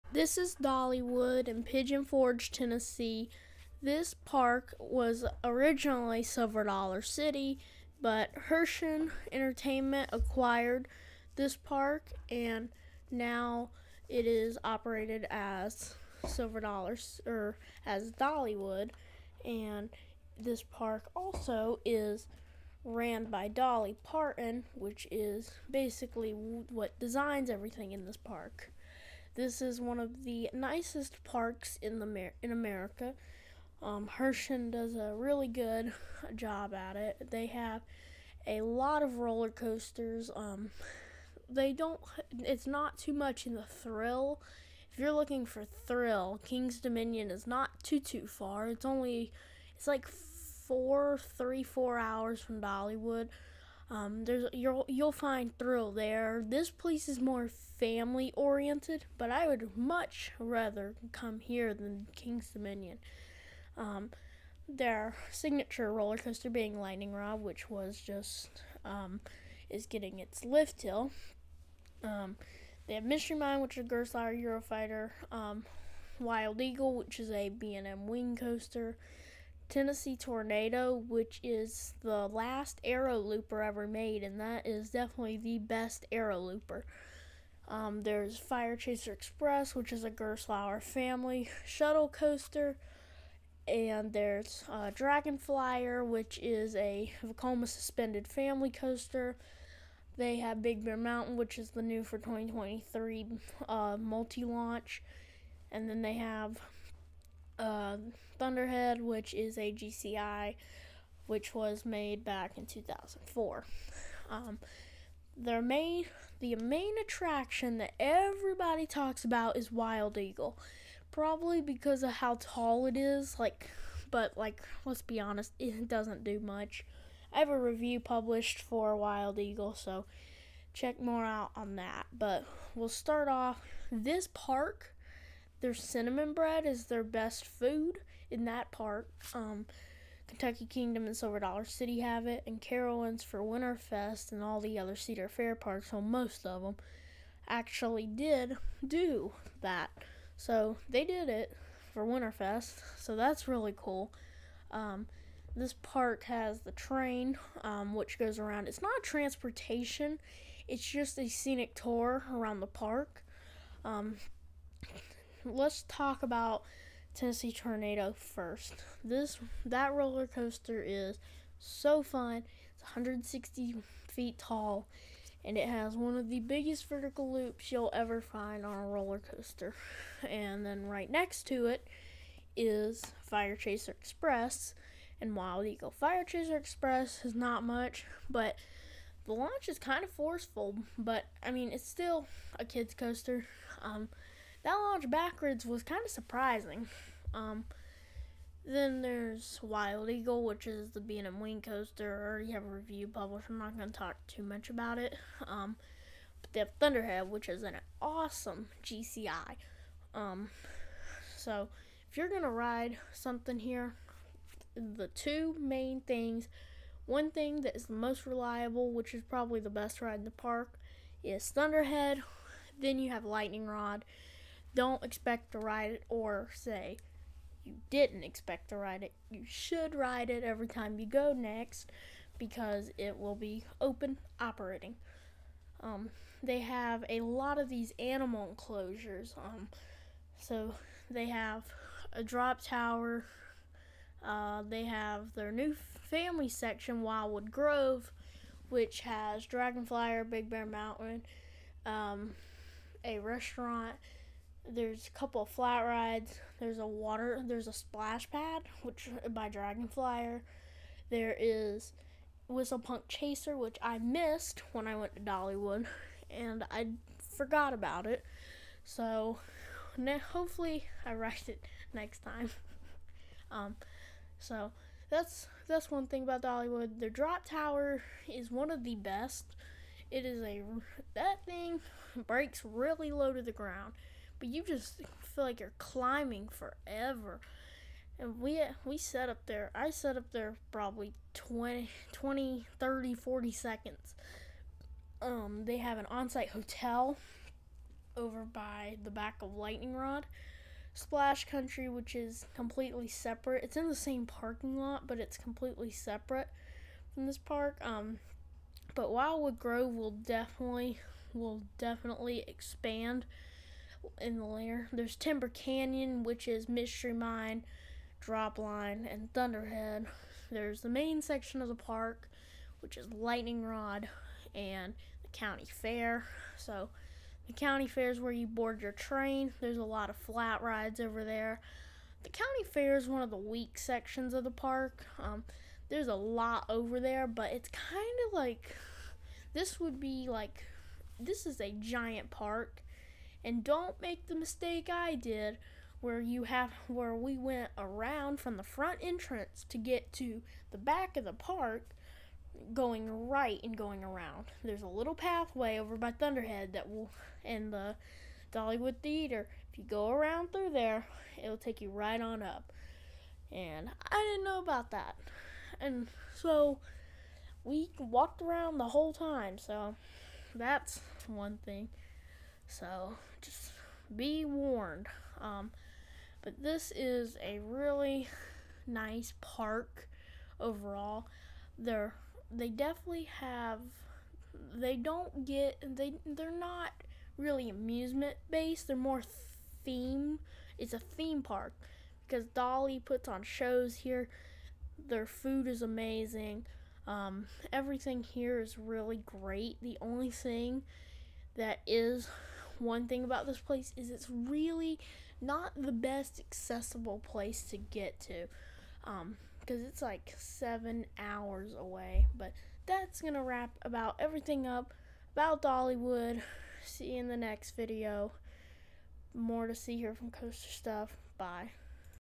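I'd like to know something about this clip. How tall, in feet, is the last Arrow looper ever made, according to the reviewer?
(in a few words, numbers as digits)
160 feet.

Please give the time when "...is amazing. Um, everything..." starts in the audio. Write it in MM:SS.
06:35.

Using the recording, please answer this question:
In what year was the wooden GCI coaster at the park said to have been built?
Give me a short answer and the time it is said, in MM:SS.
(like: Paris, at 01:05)
2004, at 01:52.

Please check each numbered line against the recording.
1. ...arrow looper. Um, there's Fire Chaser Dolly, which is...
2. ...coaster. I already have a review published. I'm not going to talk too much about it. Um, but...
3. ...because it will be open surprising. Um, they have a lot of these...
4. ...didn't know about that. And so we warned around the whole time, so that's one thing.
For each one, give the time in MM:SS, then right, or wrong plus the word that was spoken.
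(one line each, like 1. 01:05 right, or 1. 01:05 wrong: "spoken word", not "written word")
1. 01:26 wrong: "Express", not "Dolly"
2. 03:21 right
3. 03:52 wrong: "operating", not "surprising"
4. 06:04 wrong: "walked", not "warned".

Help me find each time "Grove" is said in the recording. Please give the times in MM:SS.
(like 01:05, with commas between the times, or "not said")
04:07, 05:09.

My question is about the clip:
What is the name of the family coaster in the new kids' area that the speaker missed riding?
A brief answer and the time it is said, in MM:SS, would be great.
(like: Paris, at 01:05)
Whistle Punk Chaser, at 04:22.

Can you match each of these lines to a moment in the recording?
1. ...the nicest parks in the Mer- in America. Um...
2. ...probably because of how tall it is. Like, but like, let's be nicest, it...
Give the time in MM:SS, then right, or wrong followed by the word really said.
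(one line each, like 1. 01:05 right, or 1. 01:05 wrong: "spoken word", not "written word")
1. 00:30 right
2. 02:01 wrong: "honest", not "nicest".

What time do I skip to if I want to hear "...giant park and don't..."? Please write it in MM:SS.
05:41.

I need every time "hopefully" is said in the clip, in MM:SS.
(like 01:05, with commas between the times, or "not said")
04:30.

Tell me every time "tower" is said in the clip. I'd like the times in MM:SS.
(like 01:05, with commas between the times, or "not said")
04:02, 04:37.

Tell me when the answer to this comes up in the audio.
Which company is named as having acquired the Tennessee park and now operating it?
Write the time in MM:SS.
00:08.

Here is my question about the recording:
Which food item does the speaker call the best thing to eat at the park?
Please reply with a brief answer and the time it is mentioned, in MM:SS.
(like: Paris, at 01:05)
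Cinnamon bread, at 02:15.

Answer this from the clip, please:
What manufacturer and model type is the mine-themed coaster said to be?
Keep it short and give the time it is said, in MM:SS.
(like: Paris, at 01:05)
Gerstlauer Eurofighter, at 01:13.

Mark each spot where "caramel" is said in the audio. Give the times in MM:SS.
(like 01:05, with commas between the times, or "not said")
not said.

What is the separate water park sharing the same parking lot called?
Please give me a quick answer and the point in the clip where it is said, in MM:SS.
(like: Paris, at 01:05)
Splash Country, at 05:00.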